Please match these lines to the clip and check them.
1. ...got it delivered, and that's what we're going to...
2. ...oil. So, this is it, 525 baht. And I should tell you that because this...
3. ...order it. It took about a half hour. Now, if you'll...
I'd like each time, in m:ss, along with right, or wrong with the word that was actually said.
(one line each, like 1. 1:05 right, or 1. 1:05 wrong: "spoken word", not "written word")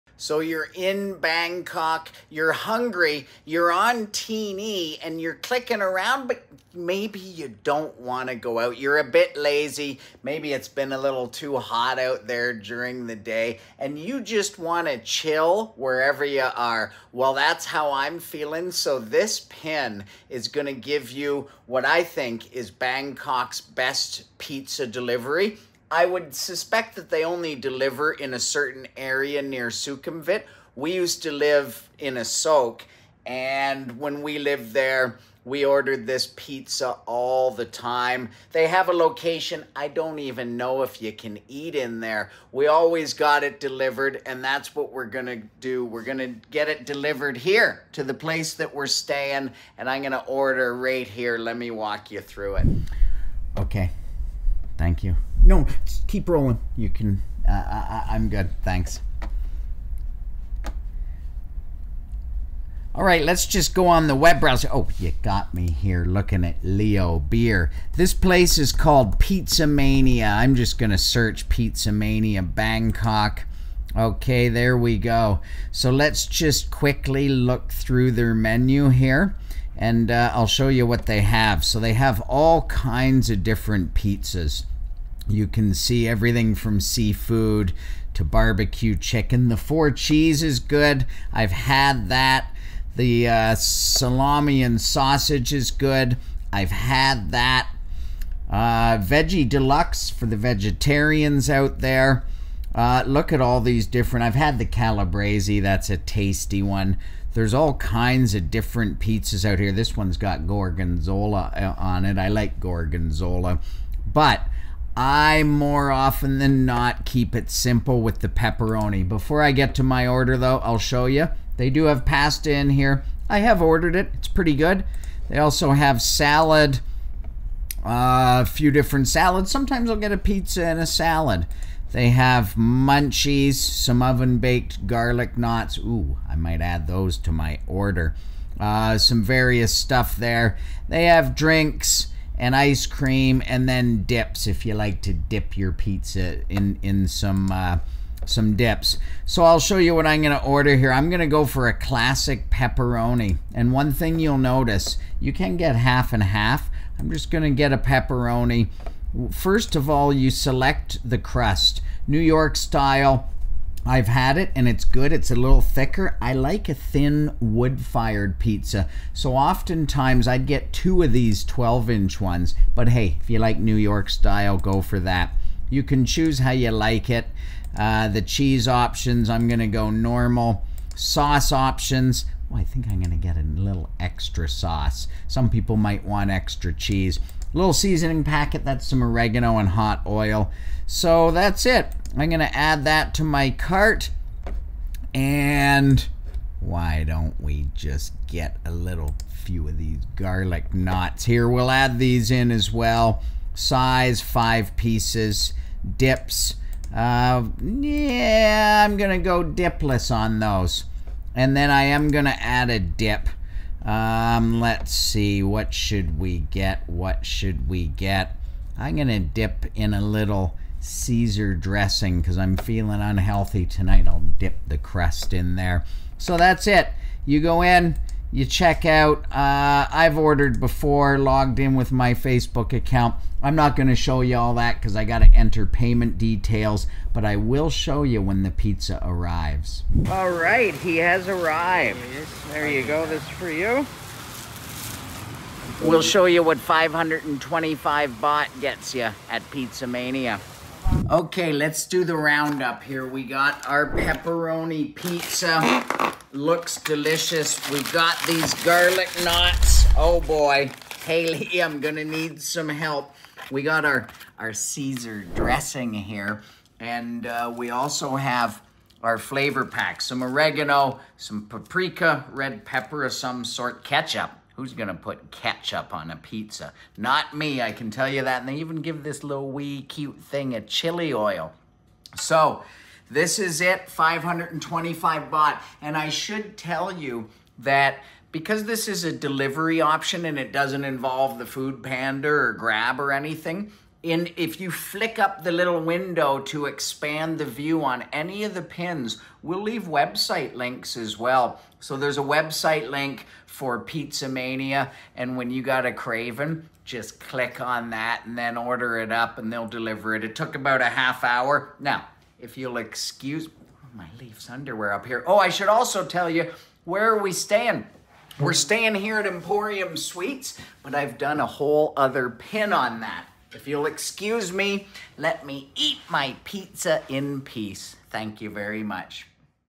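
1. 0:43 right
2. 4:41 right
3. 5:09 wrong: "deliver", not "order".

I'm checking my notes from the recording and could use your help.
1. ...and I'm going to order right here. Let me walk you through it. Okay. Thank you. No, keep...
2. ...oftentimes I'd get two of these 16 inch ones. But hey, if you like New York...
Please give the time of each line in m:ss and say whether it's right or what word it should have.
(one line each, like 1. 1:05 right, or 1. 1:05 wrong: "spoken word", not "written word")
1. 0:49 right
2. 2:49 wrong: "12", not "16".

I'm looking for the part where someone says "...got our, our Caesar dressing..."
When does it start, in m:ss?
4:23.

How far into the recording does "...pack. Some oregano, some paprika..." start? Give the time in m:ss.
4:29.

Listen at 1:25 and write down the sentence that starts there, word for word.
You can see everything from seafood to barbecue chicken.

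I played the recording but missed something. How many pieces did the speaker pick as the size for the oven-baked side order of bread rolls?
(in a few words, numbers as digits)
5.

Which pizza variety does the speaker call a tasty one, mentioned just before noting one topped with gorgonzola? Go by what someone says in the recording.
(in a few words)
Calabrese.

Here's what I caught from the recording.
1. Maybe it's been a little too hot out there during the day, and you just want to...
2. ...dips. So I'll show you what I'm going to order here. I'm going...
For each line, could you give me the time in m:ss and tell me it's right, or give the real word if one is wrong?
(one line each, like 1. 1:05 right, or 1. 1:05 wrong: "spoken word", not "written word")
1. 0:10 right
2. 2:28 right.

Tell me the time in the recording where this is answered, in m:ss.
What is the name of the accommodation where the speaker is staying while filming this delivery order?
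5:18.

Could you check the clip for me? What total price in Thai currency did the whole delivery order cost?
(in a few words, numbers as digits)
525 baht.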